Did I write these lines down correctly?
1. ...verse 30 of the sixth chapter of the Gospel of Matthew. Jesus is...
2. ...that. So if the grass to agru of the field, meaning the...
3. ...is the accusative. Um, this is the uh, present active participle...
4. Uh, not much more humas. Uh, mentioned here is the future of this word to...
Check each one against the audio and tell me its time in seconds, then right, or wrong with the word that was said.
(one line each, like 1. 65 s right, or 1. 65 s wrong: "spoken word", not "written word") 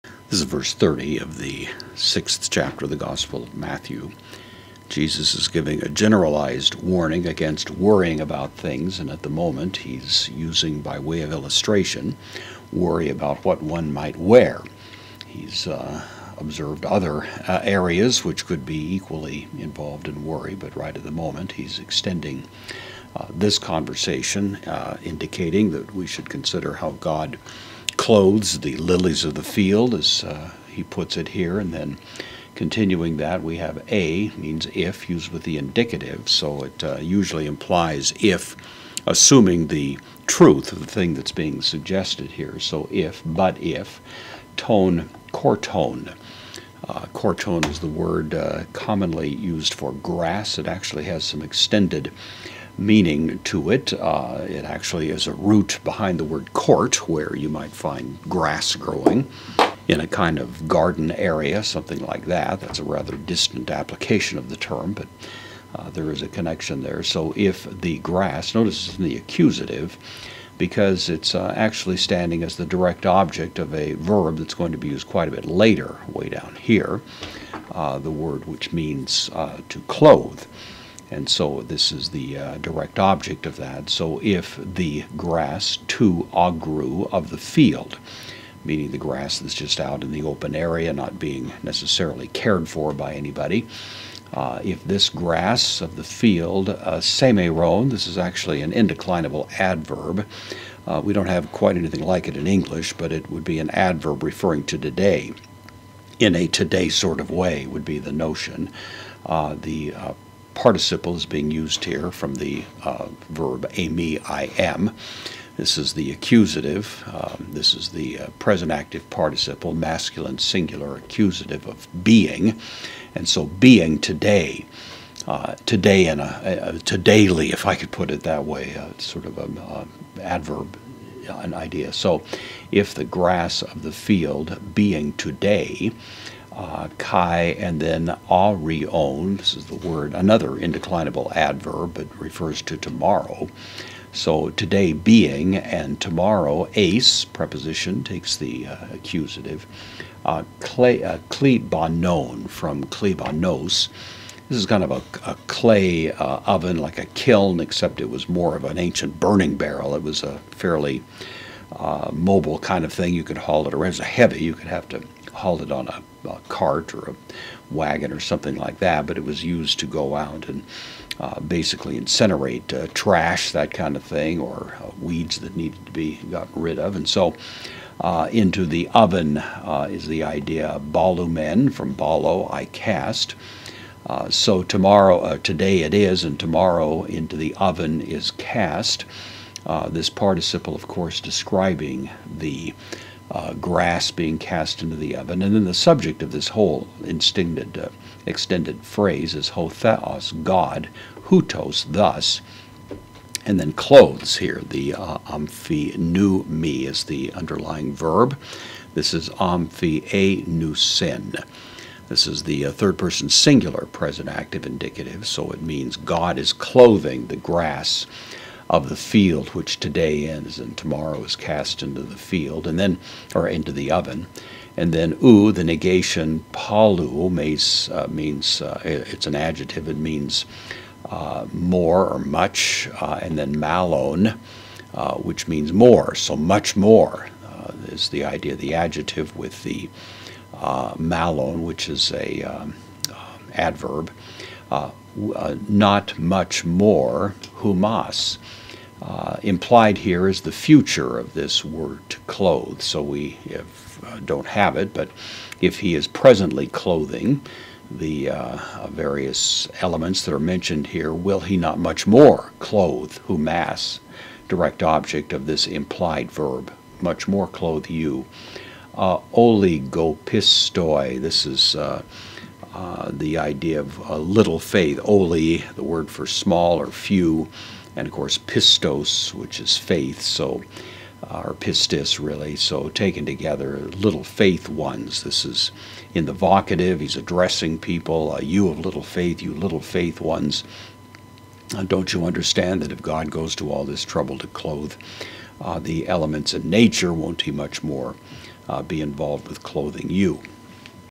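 1. 0 s right
2. 83 s right
3. 115 s right
4. 244 s wrong: "implied", not "mentioned".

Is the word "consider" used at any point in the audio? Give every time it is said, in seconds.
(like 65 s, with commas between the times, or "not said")
26 s.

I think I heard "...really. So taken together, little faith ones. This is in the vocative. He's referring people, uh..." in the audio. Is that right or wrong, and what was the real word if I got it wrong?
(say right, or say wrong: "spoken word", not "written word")
wrong: "addressing", not "referring".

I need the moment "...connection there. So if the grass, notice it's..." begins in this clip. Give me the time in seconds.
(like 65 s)
66 s.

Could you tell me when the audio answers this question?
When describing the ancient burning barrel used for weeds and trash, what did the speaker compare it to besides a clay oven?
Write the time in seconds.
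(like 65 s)
157 s.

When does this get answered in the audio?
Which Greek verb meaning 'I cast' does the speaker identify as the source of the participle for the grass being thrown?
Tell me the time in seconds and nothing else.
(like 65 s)
181 s.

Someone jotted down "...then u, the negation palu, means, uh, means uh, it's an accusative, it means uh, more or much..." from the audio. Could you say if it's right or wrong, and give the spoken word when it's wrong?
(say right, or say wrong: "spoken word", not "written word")
wrong: "adjective", not "accusative".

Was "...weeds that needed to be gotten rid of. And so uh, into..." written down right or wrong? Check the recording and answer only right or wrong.
right.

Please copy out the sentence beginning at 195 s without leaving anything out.
And then the subject of this whole uh, extended phrase is hotheos, God, hutos, thus.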